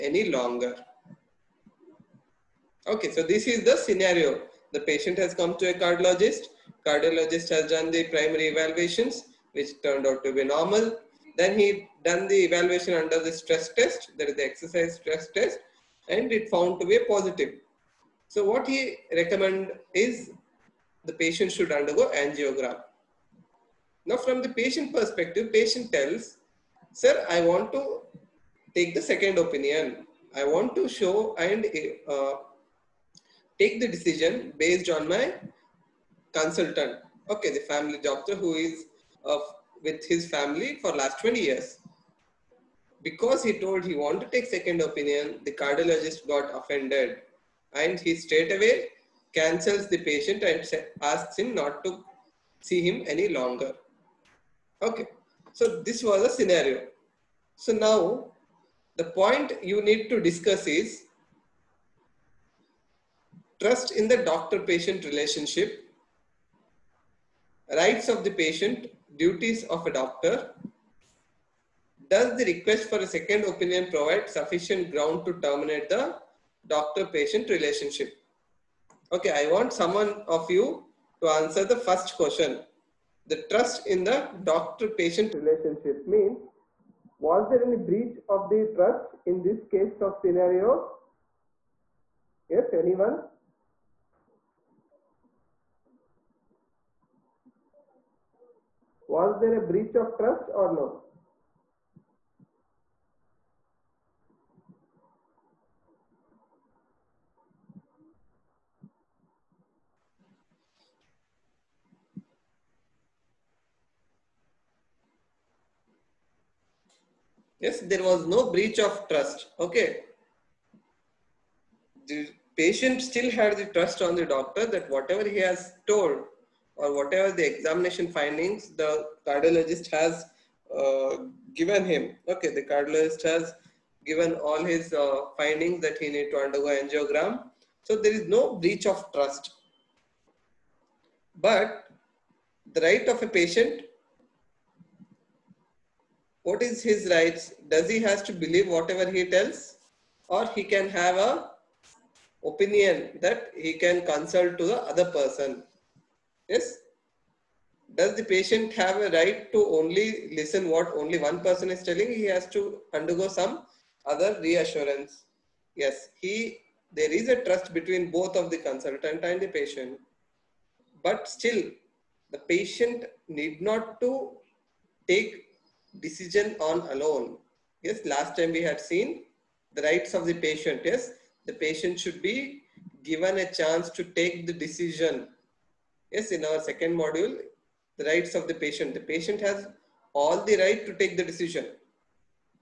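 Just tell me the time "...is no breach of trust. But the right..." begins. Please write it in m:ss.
2:18.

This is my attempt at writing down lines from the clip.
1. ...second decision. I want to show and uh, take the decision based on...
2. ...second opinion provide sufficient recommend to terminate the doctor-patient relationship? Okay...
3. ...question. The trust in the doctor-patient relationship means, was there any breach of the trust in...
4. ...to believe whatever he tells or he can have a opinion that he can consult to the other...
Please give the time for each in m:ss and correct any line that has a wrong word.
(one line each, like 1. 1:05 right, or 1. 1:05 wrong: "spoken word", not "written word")
1. 0:29 wrong: "opinion", not "decision"
2. 1:13 wrong: "ground", not "recommend"
3. 1:22 right
4. 2:28 right.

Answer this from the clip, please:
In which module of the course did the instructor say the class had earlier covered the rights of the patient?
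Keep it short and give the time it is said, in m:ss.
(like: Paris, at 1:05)
Second module, at 3:06.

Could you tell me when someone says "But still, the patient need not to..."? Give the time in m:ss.
2:51.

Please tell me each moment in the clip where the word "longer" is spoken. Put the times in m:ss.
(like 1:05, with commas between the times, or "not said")
0:00, 0:53.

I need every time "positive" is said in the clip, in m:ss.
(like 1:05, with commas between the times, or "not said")
0:17.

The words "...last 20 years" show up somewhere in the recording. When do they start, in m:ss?
0:40.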